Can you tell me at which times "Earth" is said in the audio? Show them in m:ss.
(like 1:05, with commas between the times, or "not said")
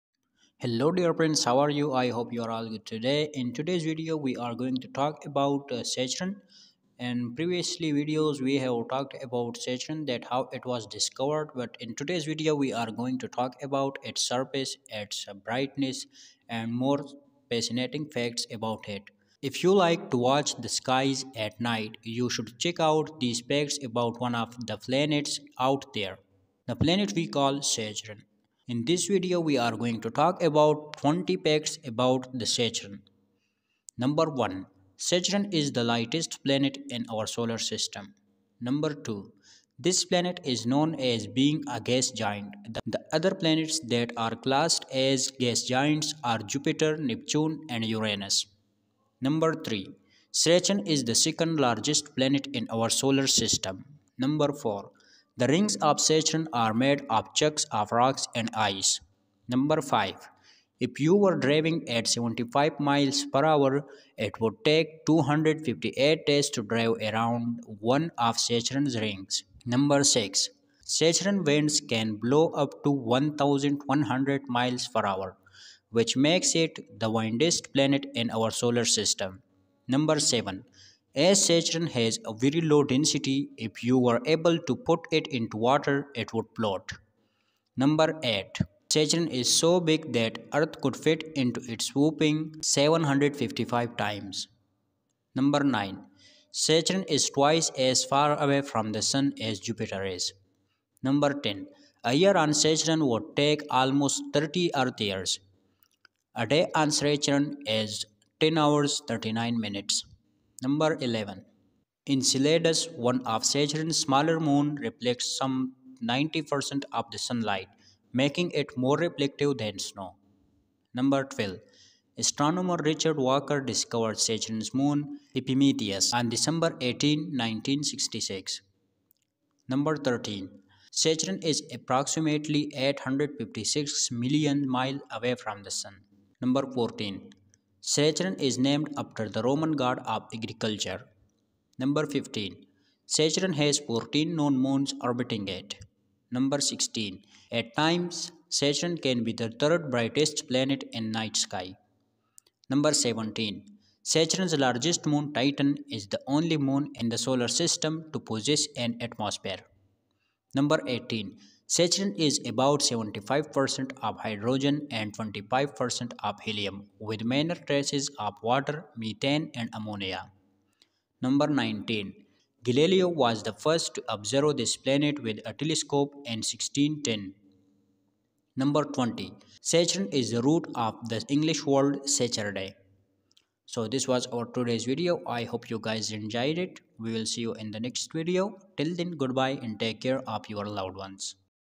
1:30, 1:44.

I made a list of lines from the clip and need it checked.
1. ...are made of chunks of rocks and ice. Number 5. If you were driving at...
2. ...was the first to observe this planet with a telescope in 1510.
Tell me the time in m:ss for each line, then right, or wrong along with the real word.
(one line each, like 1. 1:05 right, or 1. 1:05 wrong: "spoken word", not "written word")
1. 0:56 right
2. 2:53 wrong: "1610", not "1510".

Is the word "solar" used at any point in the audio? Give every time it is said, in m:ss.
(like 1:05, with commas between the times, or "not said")
0:37, 0:52, 1:18, 2:37.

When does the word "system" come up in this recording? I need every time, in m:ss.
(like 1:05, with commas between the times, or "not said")
0:37, 0:53, 1:18, 2:37.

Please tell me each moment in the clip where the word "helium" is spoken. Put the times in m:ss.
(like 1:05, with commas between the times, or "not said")
2:46.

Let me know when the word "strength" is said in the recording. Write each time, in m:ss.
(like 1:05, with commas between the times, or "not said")
not said.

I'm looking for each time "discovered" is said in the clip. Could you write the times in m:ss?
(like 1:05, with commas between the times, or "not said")
0:10, 2:03.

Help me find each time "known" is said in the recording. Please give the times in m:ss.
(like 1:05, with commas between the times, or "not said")
0:40, 2:24.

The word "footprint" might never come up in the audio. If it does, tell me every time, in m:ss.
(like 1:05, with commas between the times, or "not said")
not said.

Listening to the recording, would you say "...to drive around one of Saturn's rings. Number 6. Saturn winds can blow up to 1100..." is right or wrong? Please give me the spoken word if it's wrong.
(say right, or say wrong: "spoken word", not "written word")
right.